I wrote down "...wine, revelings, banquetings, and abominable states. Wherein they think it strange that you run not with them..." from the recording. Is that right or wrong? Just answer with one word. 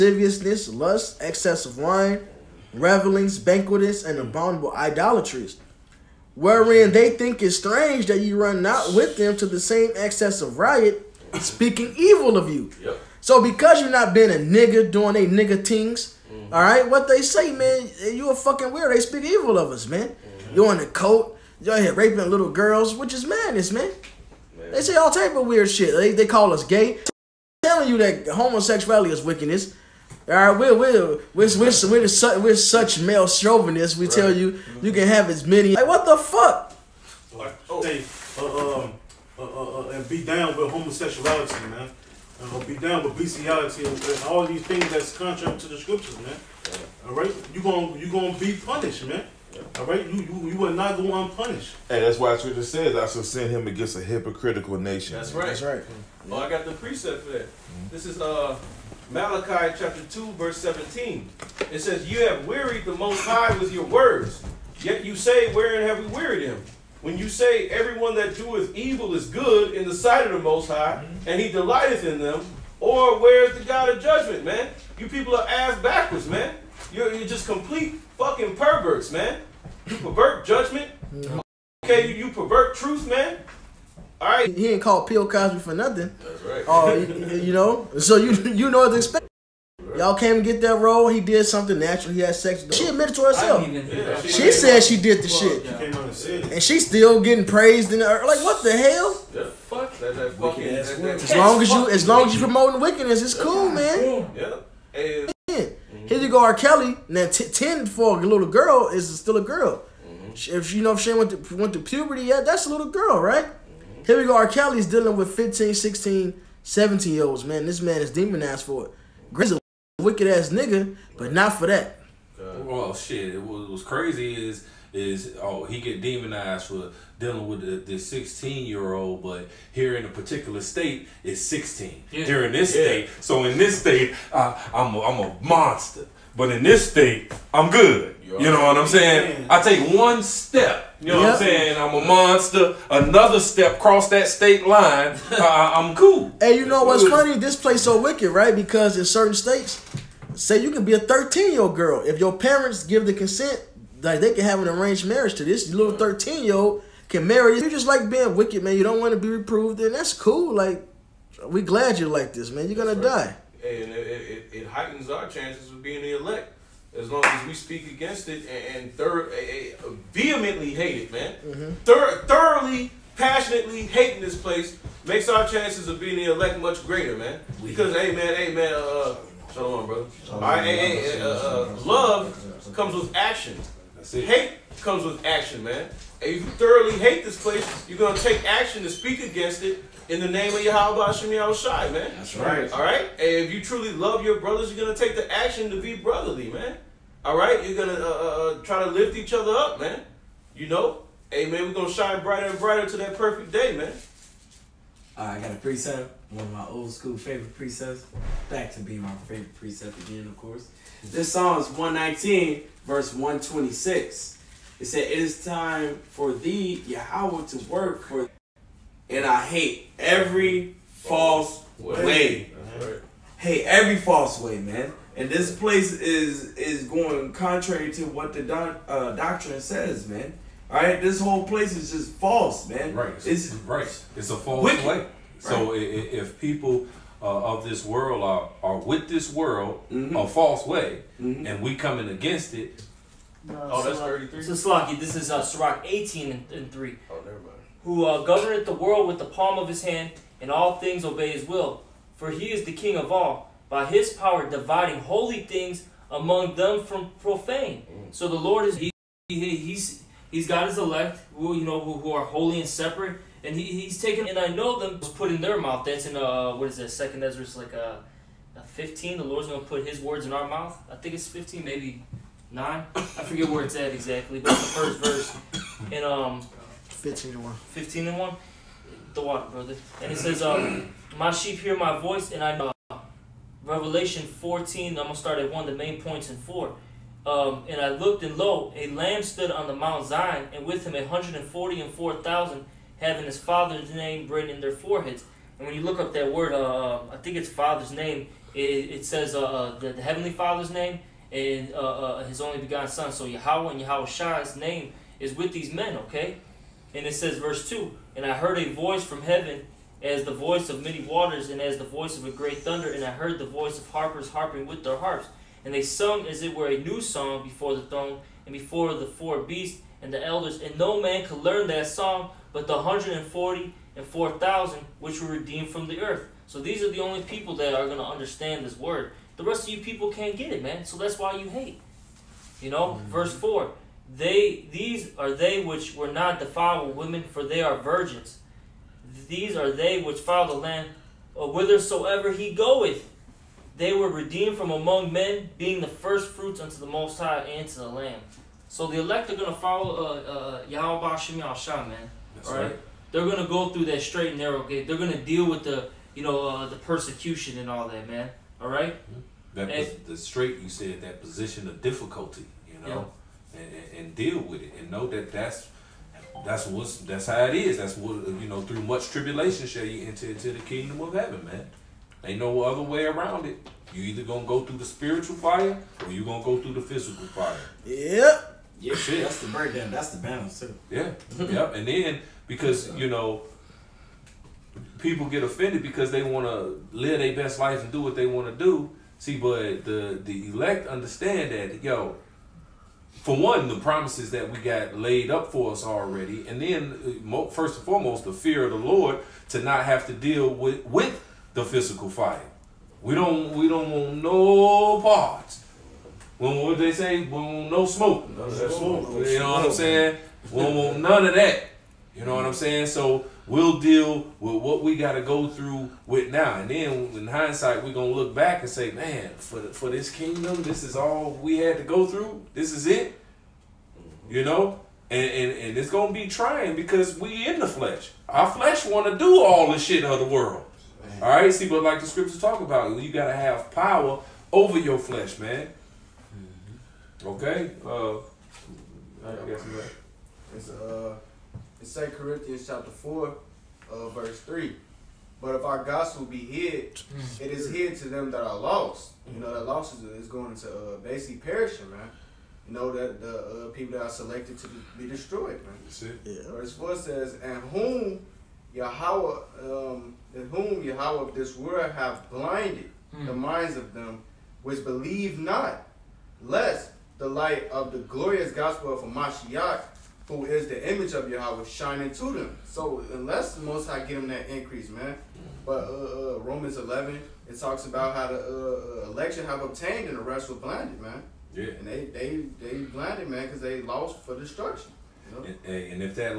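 wrong.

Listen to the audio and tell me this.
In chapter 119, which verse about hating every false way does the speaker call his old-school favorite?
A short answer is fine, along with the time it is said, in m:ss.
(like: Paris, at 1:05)
126, at 3:33.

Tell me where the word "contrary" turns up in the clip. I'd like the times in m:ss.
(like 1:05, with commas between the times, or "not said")
0:45, 3:47.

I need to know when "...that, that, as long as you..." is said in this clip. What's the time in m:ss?
1:40.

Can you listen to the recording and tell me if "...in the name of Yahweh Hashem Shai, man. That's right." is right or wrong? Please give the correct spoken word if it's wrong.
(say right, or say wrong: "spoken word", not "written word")
right.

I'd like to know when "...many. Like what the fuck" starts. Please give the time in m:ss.
0:35.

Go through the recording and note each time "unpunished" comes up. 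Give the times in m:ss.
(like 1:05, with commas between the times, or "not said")
0:51.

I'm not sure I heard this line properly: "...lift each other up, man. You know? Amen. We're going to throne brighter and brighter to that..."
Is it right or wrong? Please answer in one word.
wrong.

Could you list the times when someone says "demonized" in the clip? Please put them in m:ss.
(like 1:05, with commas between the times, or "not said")
1:58, 2:06.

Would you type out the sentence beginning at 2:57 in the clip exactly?
Because, hey, man, hey, man, uh, on, brother.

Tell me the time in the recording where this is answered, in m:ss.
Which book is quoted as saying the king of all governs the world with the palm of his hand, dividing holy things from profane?
4:05.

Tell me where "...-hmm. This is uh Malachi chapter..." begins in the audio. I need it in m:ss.
0:57.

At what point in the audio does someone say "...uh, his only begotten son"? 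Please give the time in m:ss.
5:02.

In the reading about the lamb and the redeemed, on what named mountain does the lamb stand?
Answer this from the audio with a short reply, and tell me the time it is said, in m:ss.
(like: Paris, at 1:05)
Mount Zion, at 4:49.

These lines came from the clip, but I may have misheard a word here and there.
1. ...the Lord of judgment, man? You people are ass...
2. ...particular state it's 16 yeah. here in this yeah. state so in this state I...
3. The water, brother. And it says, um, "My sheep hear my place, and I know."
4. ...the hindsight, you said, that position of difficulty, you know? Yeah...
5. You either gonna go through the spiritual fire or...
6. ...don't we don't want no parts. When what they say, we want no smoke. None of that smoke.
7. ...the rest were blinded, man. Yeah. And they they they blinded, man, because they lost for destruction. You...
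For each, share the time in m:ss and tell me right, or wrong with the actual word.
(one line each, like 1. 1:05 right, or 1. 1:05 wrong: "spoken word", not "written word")
1. 1:13 wrong: "God", not "Lord"
2. 2:10 right
3. 4:39 wrong: "voice", not "place"
4. 6:00 wrong: "straight", not "hindsight"
5. 6:13 right
6. 6:43 right
7. 8:00 right.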